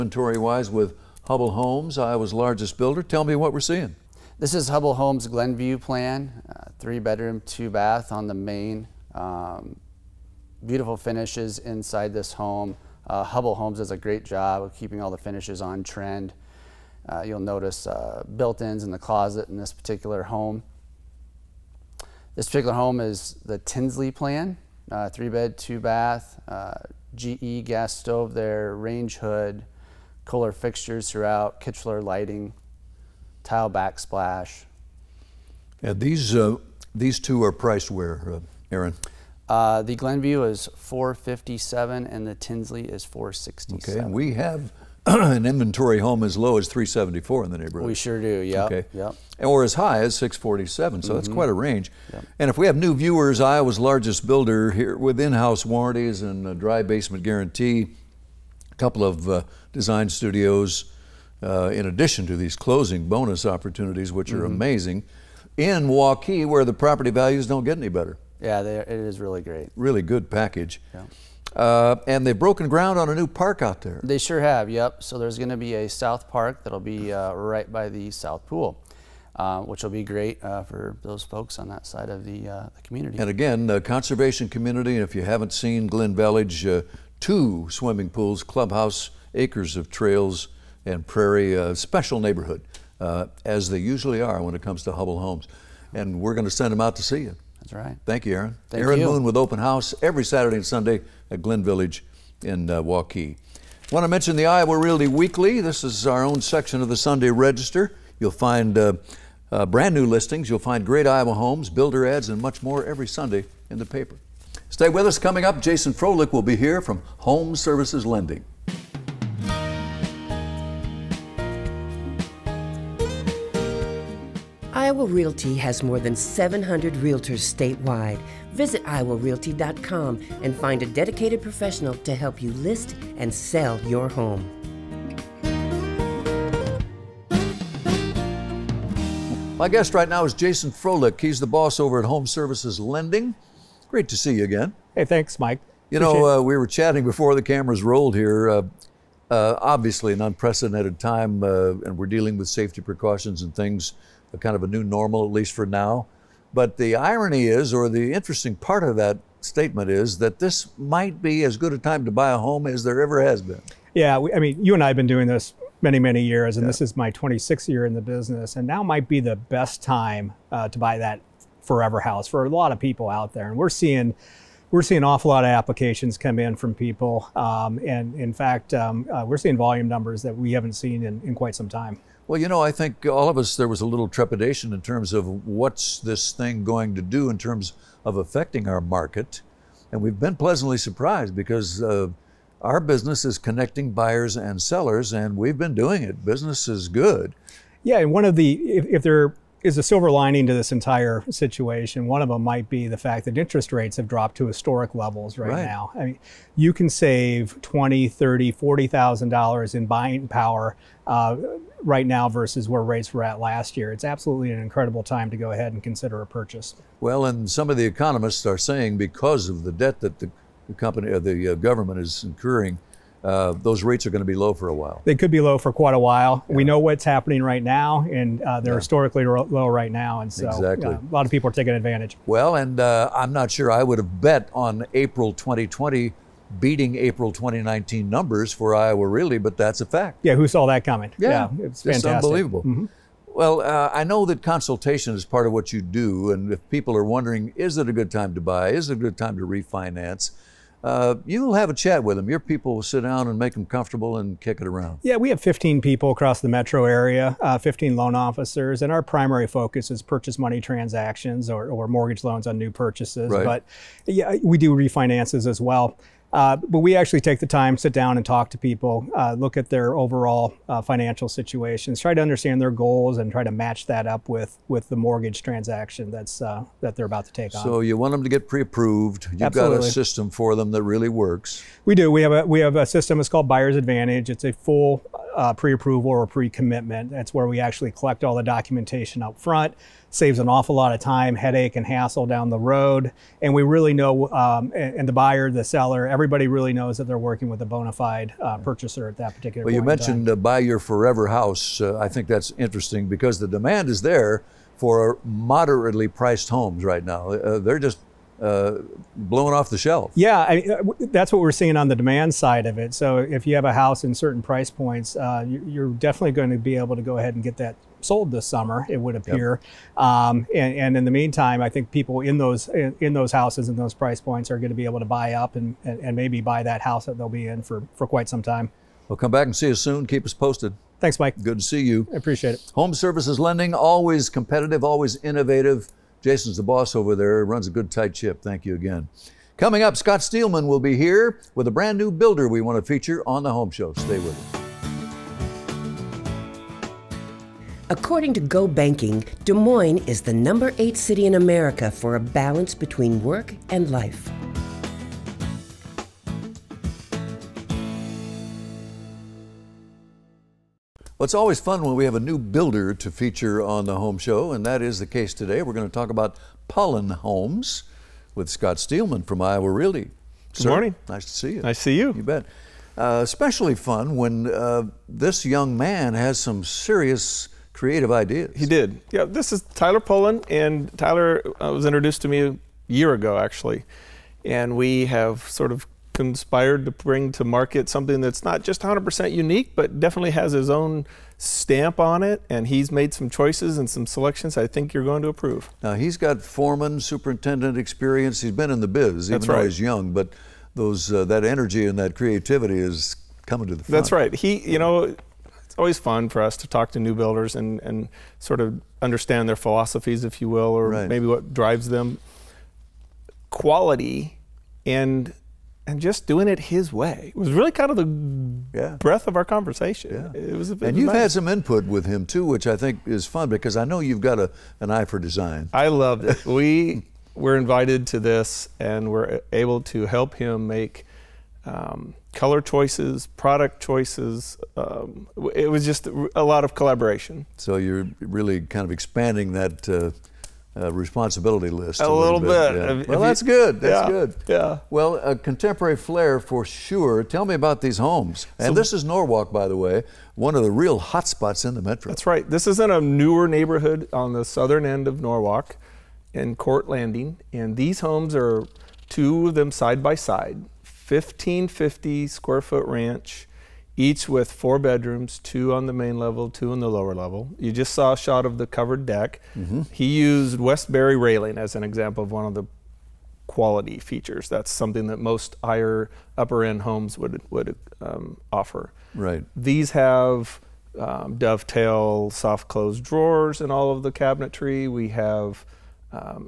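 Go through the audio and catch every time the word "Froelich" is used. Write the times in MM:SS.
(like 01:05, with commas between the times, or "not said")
01:55, 02:20.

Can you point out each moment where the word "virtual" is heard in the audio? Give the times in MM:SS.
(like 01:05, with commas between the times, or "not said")
not said.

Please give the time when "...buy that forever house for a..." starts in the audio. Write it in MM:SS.
02:50.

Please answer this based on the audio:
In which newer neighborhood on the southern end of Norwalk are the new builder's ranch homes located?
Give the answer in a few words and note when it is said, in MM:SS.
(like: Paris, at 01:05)
Court Landing, at 07:36.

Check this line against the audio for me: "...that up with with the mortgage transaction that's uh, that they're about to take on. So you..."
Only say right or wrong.
right.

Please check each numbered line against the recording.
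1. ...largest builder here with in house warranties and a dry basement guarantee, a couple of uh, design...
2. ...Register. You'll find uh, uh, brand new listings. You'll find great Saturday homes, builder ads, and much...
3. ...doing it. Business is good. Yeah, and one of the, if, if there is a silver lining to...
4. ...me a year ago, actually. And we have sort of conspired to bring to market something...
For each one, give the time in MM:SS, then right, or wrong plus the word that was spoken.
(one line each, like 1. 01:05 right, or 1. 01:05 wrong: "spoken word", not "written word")
1. 00:53 right
2. 01:47 wrong: "Iowa", not "Saturday"
3. 03:15 right
4. 06:22 right.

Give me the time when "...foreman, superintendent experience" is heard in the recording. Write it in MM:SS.
06:36.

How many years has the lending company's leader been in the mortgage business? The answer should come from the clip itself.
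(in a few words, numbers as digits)
26.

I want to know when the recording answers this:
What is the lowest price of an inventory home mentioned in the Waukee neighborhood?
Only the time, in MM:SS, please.
00:46.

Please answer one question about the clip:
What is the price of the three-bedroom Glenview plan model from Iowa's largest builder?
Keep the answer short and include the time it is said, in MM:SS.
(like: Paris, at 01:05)
457, at 00:39.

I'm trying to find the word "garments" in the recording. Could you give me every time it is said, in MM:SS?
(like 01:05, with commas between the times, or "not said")
not said.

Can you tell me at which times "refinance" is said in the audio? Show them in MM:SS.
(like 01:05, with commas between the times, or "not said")
04:09, 04:24.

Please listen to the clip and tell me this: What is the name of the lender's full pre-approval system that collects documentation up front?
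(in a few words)
Buyer's Advantage.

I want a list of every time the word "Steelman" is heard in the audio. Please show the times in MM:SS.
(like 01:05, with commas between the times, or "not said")
05:40, 06:08.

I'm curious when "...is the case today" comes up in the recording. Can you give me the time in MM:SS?
06:04.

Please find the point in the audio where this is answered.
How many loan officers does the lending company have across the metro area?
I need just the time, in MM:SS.
04:17.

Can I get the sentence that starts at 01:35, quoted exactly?
And we're going to send them out to see you.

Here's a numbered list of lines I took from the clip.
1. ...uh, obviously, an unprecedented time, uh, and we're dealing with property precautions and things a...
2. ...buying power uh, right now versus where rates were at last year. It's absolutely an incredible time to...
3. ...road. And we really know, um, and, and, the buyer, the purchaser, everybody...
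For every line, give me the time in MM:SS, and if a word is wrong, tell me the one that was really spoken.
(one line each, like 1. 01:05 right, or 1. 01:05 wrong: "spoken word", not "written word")
1. 02:29 wrong: "safety", not "property"
2. 03:29 right
3. 04:52 wrong: "seller", not "purchaser".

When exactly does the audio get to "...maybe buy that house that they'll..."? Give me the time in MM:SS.
05:26.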